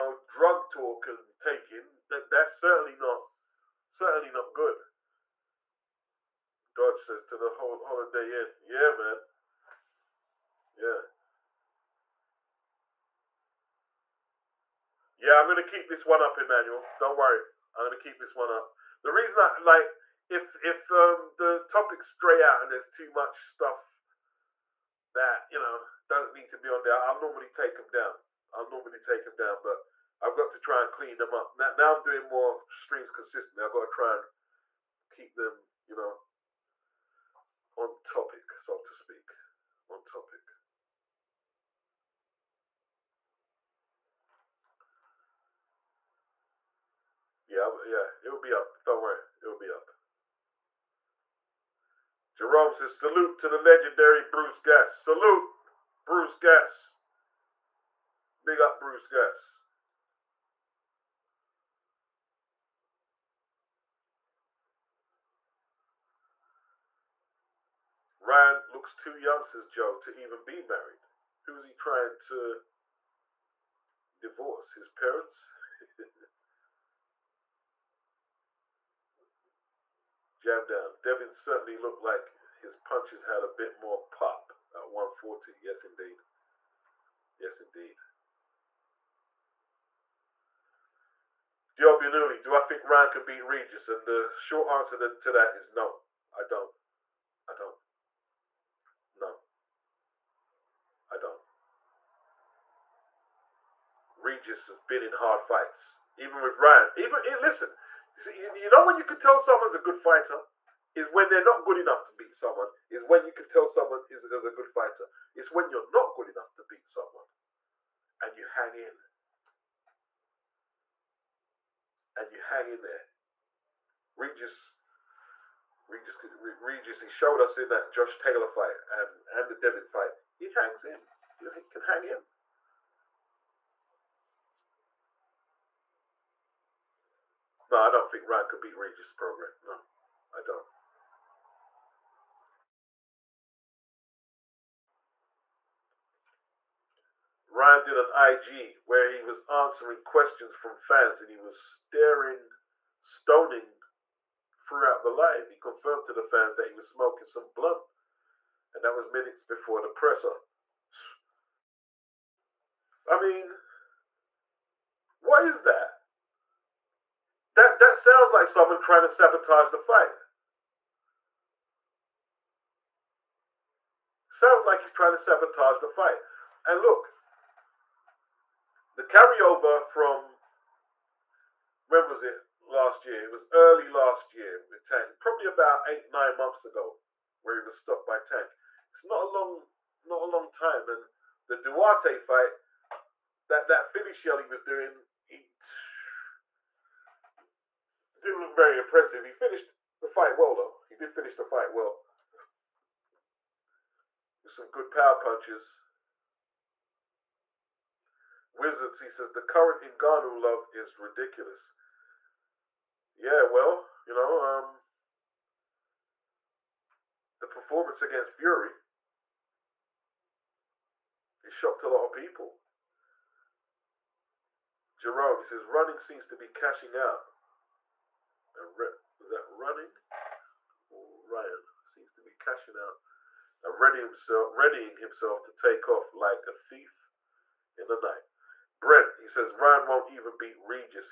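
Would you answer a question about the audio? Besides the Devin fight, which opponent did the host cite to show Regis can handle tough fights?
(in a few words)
Josh Taylor.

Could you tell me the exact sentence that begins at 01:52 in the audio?
Is when you can tell someone is, is a good fighter.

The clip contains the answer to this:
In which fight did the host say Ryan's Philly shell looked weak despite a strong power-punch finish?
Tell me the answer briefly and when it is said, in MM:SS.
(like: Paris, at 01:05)
Duarte, at 03:11.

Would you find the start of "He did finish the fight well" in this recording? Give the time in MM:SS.
03:20.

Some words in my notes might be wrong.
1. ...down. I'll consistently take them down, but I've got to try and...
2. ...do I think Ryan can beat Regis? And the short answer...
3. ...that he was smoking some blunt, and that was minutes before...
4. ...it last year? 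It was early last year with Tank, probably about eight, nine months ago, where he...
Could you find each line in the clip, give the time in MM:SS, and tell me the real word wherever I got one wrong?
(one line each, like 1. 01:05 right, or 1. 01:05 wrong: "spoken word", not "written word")
1. 00:27 wrong: "normally", not "consistently"
2. 01:32 right
3. 02:36 right
4. 03:02 right.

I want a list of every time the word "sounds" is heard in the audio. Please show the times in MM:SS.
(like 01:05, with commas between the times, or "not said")
02:47, 02:54.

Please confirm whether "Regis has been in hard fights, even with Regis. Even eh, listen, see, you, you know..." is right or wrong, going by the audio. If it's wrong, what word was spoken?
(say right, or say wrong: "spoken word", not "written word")
wrong: "Ryan", not "Regis".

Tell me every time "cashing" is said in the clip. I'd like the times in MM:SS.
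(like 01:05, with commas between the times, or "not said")
03:46, 03:52.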